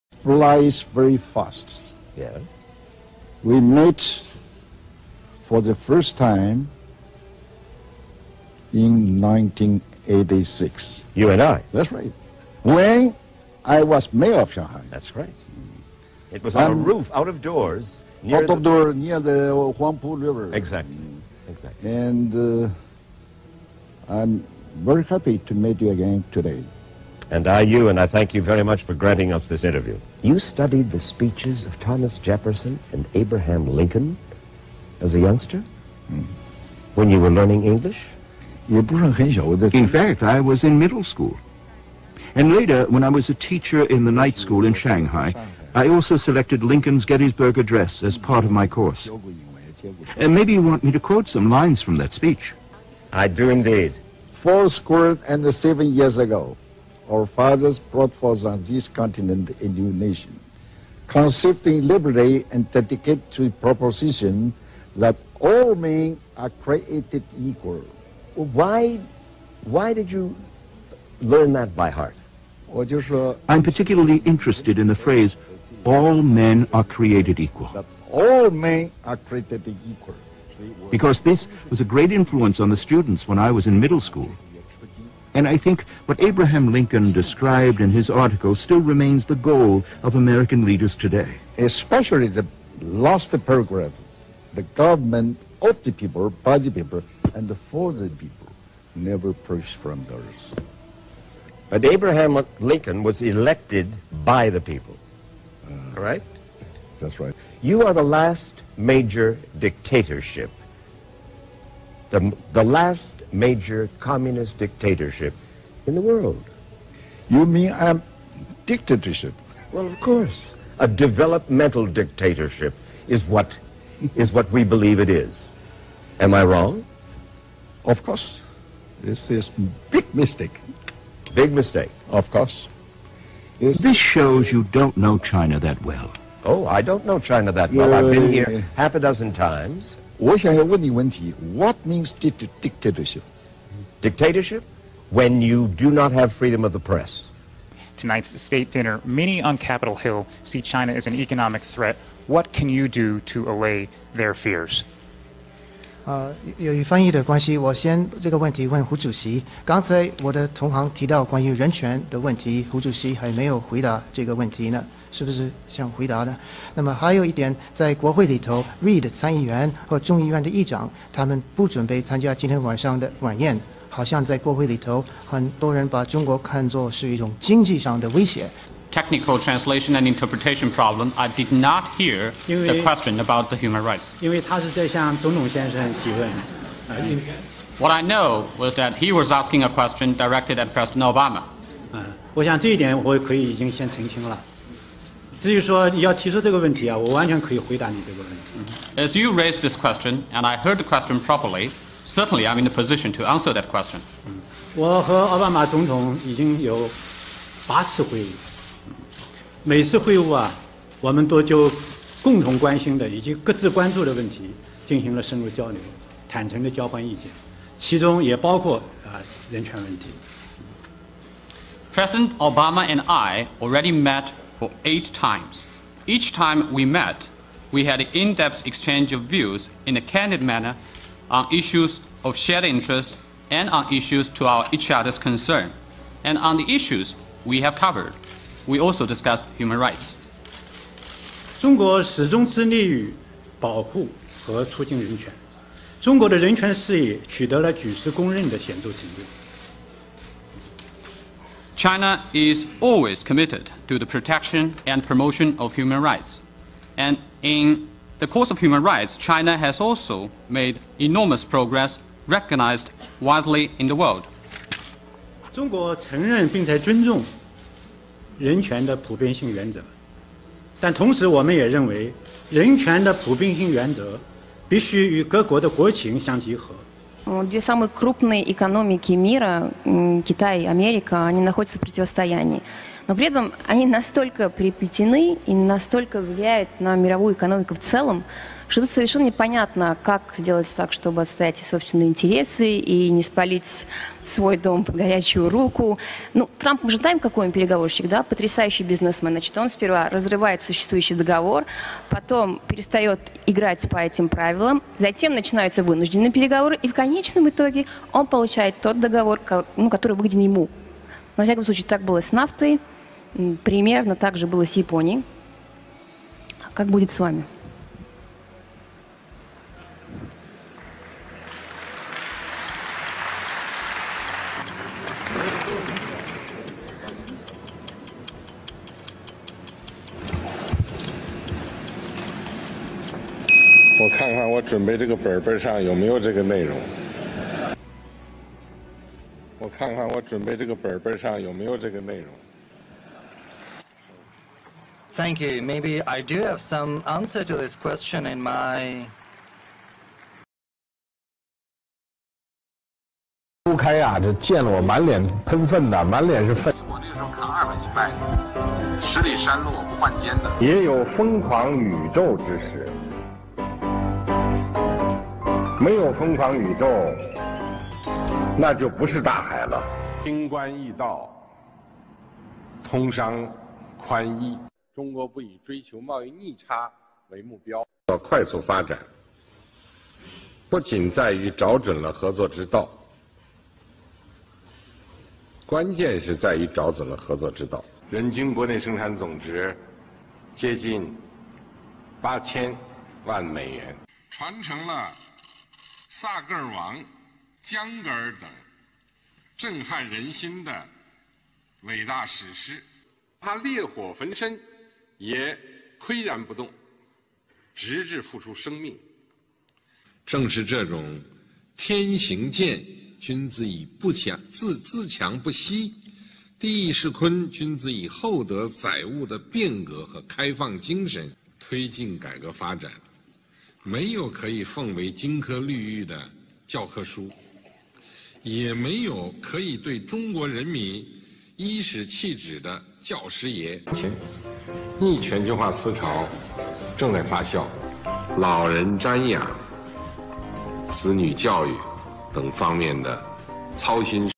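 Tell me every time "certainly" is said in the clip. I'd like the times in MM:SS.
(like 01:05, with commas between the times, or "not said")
03:22.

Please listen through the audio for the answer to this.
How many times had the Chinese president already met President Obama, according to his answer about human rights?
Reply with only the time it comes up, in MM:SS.
03:44.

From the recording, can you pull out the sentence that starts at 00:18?
out of door near the Huangpu River.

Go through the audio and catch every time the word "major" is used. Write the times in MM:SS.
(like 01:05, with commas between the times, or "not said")
01:48, 01:53.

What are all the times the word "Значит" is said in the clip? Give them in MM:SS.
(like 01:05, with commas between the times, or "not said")
04:59.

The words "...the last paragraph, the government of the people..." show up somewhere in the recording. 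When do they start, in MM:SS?
01:32.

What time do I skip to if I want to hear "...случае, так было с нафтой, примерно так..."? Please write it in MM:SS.
05:11.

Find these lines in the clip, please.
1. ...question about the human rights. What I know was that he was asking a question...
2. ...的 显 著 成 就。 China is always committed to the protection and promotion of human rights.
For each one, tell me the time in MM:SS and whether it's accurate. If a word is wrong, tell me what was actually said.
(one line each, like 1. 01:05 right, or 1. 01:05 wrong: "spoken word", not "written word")
1. 03:02 right
2. 04:08 right.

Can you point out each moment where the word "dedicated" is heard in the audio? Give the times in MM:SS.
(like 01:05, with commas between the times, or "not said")
01:02.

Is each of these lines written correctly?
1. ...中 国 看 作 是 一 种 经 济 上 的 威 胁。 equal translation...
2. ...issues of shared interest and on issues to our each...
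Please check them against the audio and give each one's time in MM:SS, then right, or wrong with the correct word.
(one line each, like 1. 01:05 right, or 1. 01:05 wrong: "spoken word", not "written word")
1. 02:56 wrong: "technical", not "equal"
2. 03:51 right.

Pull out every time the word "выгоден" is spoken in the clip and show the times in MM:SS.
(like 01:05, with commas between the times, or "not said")
05:10.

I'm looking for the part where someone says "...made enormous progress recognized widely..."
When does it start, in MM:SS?
04:20.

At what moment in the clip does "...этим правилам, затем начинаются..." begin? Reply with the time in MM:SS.
05:03.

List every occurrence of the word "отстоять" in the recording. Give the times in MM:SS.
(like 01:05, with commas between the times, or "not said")
04:51.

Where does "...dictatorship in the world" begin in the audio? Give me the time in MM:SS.
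01:54.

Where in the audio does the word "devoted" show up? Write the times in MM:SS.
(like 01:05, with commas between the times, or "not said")
not said.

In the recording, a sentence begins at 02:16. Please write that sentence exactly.
Oh, I don't know China that well.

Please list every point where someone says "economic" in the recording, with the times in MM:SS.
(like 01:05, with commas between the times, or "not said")
02:31.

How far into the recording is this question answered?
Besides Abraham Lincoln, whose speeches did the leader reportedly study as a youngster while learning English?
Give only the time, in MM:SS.
00:31.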